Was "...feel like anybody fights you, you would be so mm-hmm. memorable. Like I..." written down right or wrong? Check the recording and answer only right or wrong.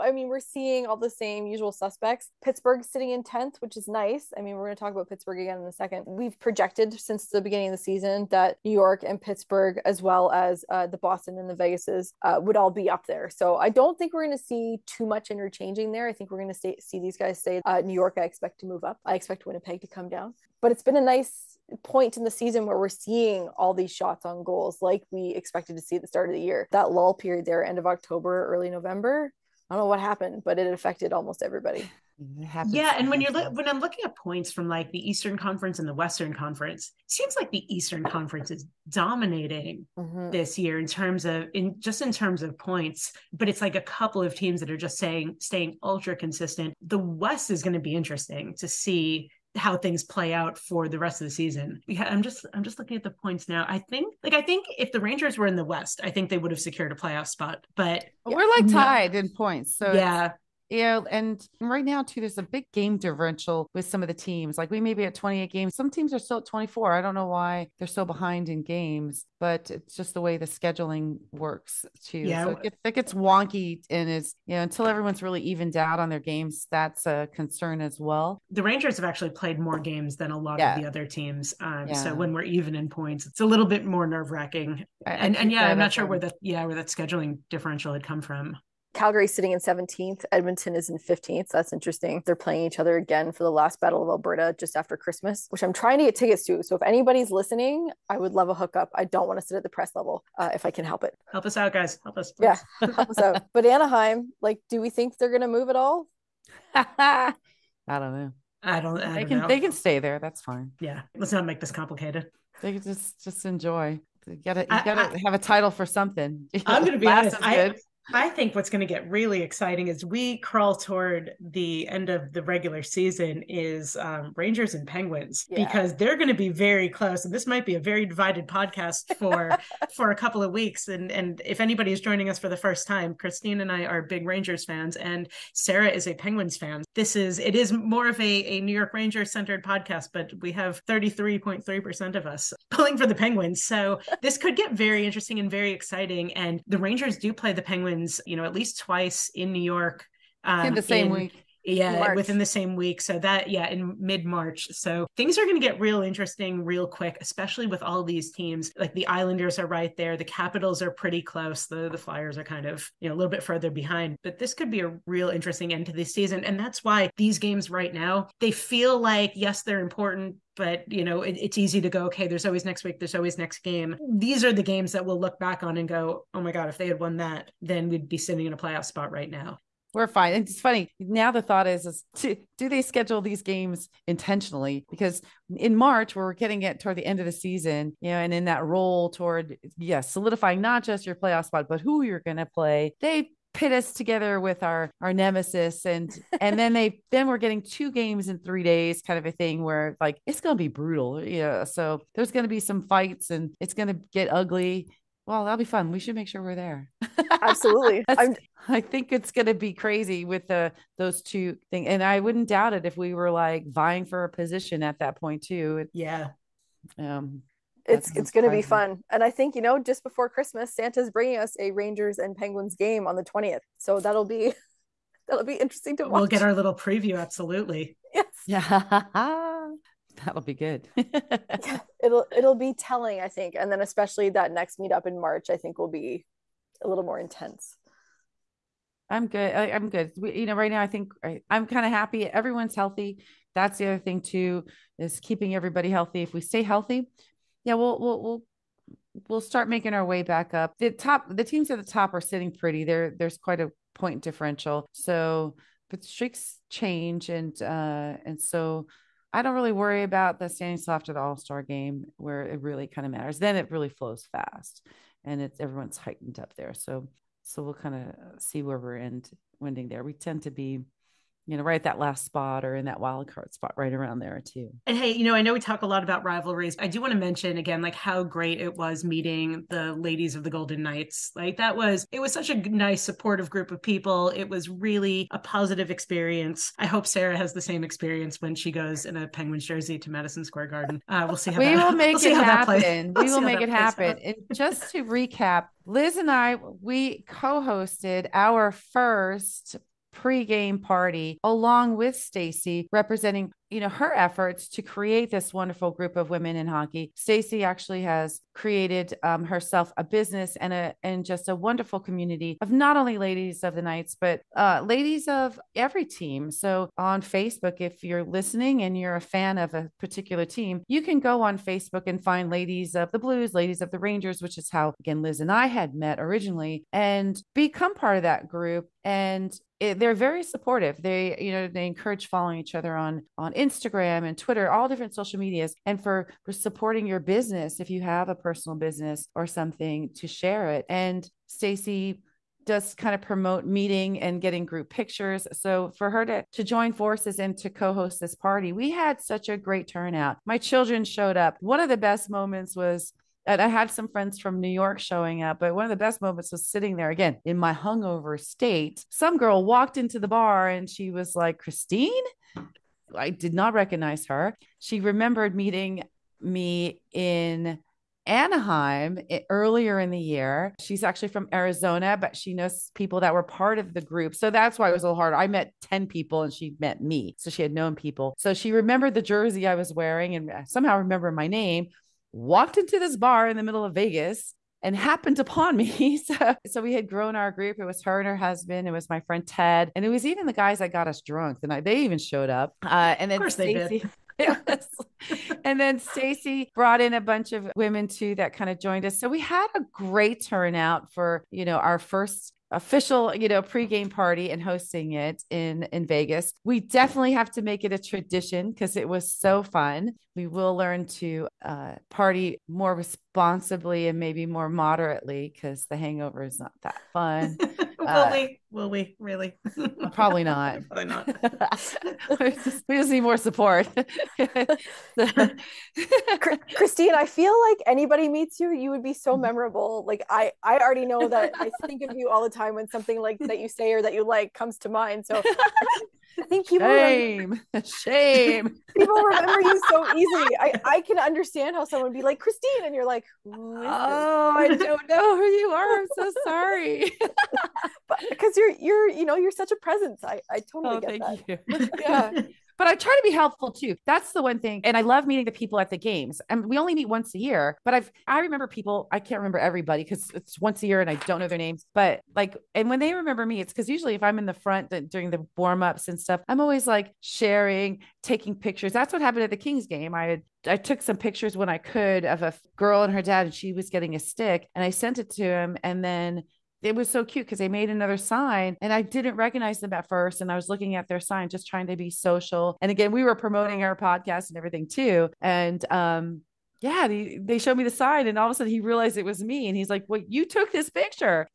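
wrong.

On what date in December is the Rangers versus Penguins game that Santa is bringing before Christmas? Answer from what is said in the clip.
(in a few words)
20th.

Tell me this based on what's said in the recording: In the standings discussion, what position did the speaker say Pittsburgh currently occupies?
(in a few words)
10th.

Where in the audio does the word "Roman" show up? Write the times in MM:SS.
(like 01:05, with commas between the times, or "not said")
not said.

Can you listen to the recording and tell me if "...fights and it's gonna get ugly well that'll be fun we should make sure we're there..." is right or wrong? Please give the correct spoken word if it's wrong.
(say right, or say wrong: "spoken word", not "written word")
right.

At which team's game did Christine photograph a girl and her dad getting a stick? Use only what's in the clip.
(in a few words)
Kings.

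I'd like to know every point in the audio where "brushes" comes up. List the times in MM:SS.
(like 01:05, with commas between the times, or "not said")
not said.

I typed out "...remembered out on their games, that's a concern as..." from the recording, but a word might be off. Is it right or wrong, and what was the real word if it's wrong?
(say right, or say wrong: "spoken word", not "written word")
wrong: "evened", not "remembered".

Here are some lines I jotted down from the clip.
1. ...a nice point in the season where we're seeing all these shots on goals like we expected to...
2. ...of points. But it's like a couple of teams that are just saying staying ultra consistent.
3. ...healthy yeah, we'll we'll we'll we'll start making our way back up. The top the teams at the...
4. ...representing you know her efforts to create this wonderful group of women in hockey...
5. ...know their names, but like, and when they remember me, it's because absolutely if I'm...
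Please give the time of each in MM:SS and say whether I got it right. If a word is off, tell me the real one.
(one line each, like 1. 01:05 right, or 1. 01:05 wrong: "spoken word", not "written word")
1. 00:20 right
2. 00:42 right
3. 04:06 right
4. 05:02 right
5. 07:41 wrong: "usually", not "absolutely".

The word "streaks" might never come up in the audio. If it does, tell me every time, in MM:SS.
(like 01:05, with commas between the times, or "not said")
04:16.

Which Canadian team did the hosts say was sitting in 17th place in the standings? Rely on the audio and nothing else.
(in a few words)
Calgary.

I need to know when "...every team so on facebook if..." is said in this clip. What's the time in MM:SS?
05:15.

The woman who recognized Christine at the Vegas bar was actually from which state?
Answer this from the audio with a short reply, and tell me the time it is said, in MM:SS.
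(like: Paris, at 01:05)
Arizona, at 06:11.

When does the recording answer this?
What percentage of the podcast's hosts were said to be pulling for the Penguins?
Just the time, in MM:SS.
02:20.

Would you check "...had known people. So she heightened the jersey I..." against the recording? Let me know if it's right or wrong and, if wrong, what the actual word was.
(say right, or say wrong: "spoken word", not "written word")
wrong: "remembered", not "heightened".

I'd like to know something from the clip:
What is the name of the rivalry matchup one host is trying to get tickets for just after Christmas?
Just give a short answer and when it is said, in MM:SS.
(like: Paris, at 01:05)
Battle of Alberta, at 01:33.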